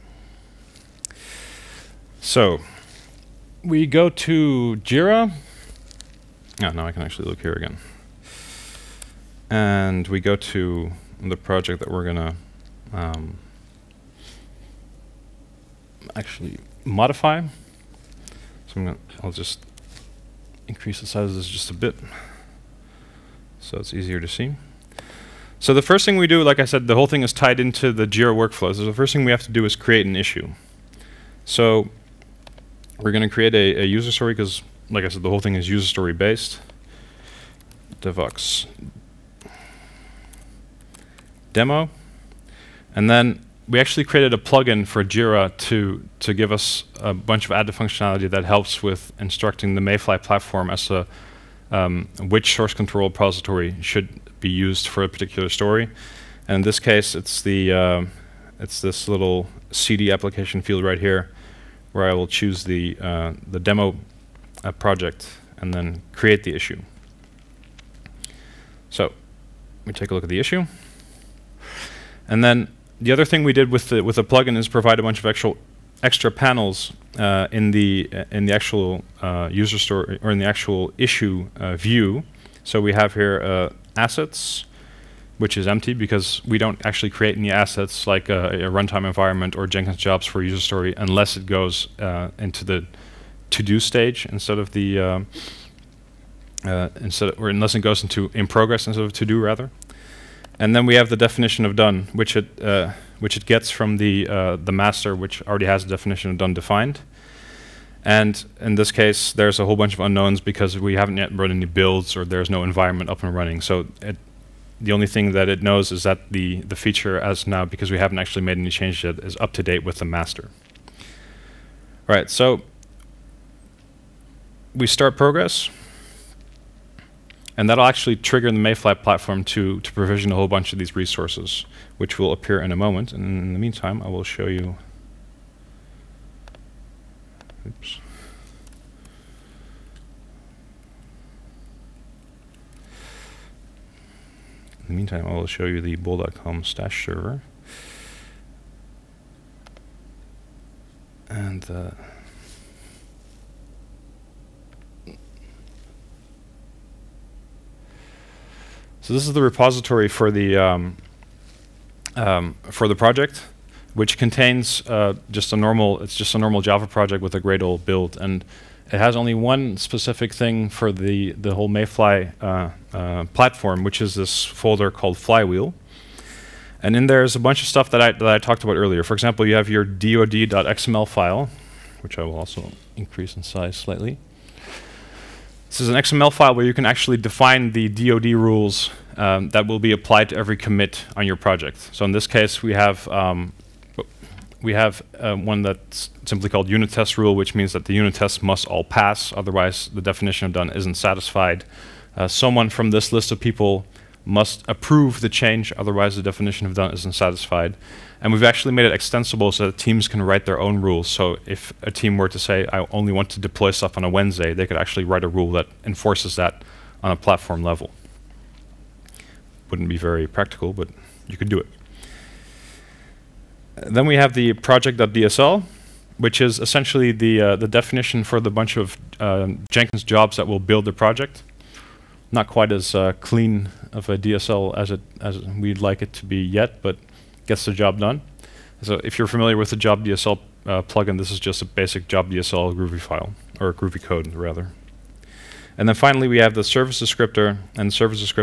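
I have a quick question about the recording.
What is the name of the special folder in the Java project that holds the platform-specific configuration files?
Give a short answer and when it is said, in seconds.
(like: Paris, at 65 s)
Flywheel, at 175 s.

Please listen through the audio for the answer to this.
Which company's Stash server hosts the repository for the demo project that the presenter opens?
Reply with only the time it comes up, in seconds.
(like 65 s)
145 s.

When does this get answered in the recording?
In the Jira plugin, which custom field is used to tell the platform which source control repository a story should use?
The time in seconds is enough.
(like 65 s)
59 s.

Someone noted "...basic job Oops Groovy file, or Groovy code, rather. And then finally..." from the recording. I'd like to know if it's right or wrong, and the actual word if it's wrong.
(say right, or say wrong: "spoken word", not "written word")
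wrong: "DSL", not "Oops".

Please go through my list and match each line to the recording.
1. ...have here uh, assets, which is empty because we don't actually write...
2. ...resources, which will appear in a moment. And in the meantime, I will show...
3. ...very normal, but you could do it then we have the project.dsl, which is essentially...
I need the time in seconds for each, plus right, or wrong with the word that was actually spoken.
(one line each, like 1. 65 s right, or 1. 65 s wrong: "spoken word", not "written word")
1. 82 s wrong: "create", not "write"
2. 130 s right
3. 219 s wrong: "practical", not "normal".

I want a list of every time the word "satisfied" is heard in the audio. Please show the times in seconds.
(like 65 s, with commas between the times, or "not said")
200 s, 207 s.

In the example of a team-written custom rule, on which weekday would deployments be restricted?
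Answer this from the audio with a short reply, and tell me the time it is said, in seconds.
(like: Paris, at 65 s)
Wednesday, at 214 s.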